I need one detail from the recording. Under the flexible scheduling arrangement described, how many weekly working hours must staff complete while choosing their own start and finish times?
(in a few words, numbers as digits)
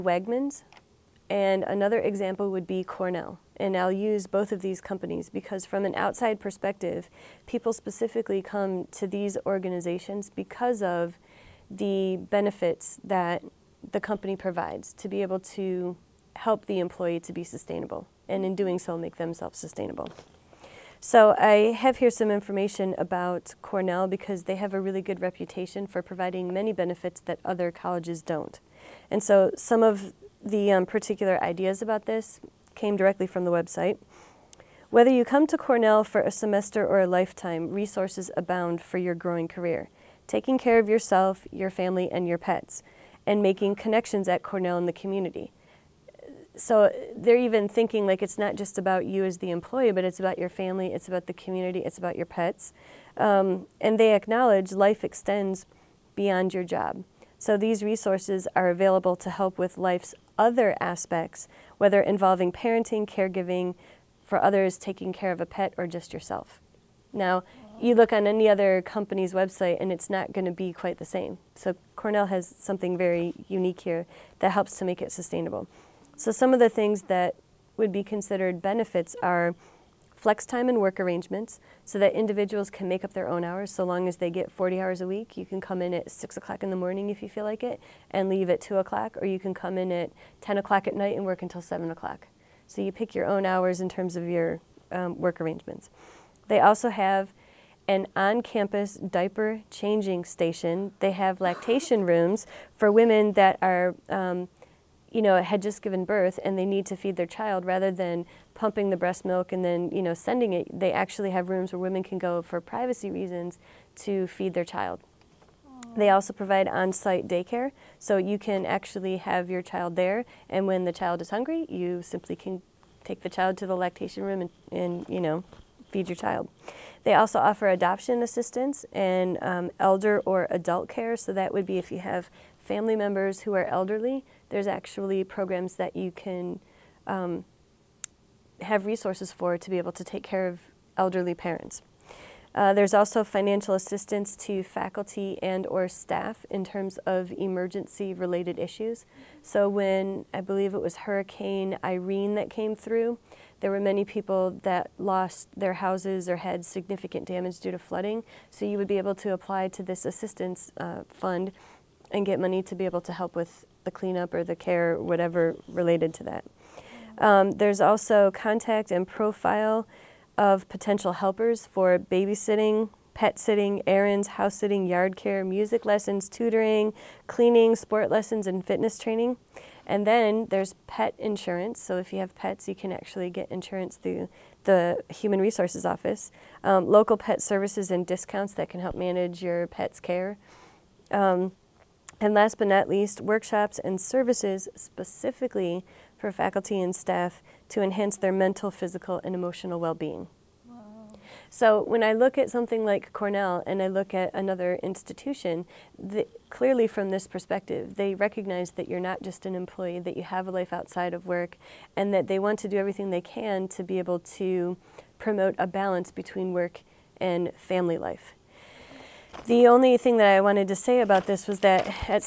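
40.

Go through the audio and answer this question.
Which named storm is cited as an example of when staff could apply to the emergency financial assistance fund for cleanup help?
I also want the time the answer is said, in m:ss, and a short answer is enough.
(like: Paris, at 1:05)
Hurricane Irene, at 2:30.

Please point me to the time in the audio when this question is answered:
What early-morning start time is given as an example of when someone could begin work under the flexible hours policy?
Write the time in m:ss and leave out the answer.
1:26.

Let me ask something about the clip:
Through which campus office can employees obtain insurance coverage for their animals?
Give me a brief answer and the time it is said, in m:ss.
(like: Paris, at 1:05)
Human Resources Office, at 3:05.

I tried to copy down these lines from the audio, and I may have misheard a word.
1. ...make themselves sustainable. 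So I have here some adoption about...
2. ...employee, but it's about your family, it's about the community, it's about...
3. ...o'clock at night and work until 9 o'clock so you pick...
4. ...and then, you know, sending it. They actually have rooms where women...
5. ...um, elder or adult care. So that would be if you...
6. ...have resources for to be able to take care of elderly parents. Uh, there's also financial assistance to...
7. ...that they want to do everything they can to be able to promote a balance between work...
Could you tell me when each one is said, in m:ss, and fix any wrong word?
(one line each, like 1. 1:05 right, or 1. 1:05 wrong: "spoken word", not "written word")
1. 0:18 wrong: "information", not "adoption"
2. 0:49 right
3. 1:30 wrong: "7", not "9"
4. 1:49 right
5. 2:09 right
6. 2:18 right
7. 3:32 right.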